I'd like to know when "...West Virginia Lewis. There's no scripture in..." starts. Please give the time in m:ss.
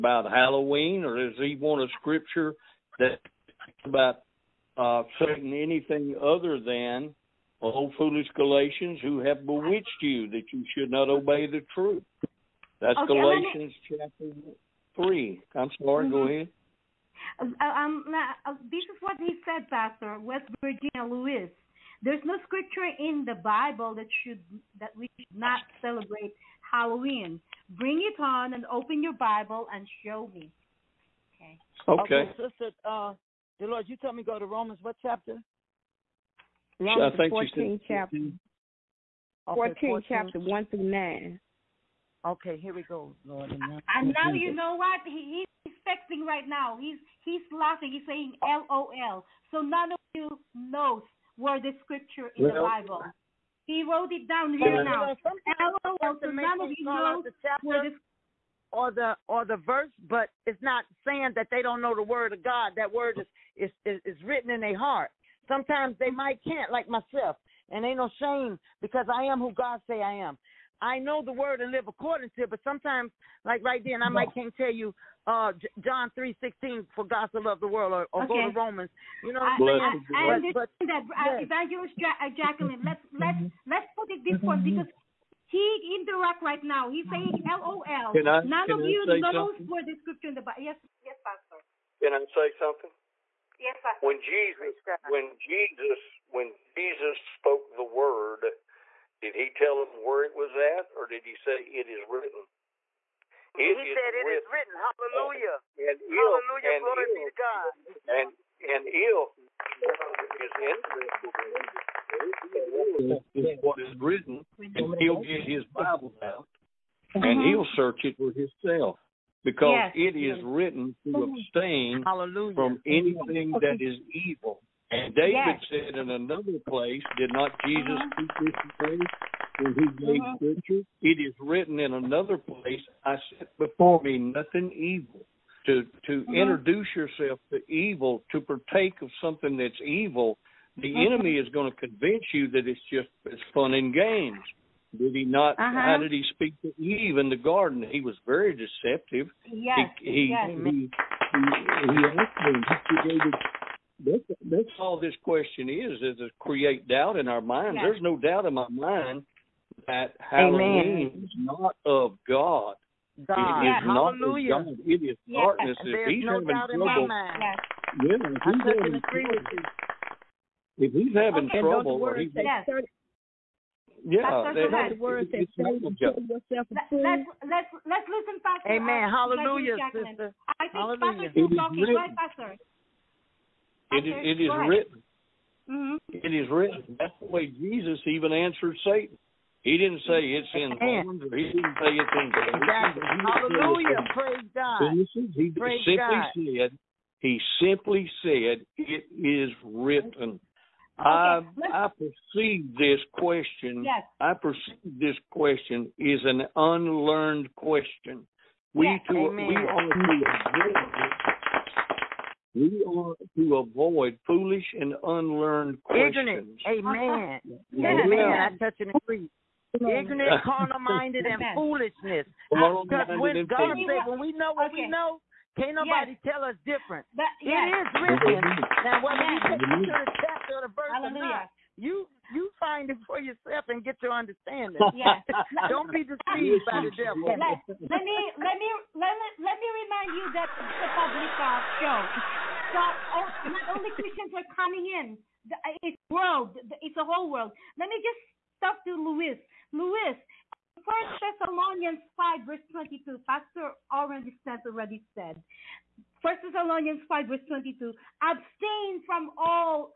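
0:20.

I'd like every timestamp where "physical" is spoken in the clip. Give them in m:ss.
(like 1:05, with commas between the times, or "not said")
not said.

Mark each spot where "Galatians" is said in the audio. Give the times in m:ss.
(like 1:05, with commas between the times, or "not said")
0:08, 0:13.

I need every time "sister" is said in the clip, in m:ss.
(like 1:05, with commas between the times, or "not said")
0:32, 2:59.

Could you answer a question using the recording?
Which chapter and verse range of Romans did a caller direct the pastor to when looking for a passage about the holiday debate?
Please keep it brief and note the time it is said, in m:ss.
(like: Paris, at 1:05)
Romans 14:1-9, at 0:39.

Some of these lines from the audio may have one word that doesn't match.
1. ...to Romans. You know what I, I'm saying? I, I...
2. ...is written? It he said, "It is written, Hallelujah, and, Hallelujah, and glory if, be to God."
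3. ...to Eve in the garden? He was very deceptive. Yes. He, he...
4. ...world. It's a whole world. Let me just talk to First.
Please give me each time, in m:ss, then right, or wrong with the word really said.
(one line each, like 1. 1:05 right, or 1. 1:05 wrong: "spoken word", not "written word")
1. 1:18 right
2. 1:41 right
3. 2:26 right
4. 4:06 wrong: "Louis", not "First".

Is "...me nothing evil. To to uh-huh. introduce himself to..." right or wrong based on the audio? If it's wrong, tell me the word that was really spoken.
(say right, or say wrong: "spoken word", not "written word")
wrong: "yourself", not "himself".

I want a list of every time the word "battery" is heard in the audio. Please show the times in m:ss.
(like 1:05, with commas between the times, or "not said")
not said.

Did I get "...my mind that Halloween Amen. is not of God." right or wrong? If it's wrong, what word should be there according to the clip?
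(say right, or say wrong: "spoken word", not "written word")
right.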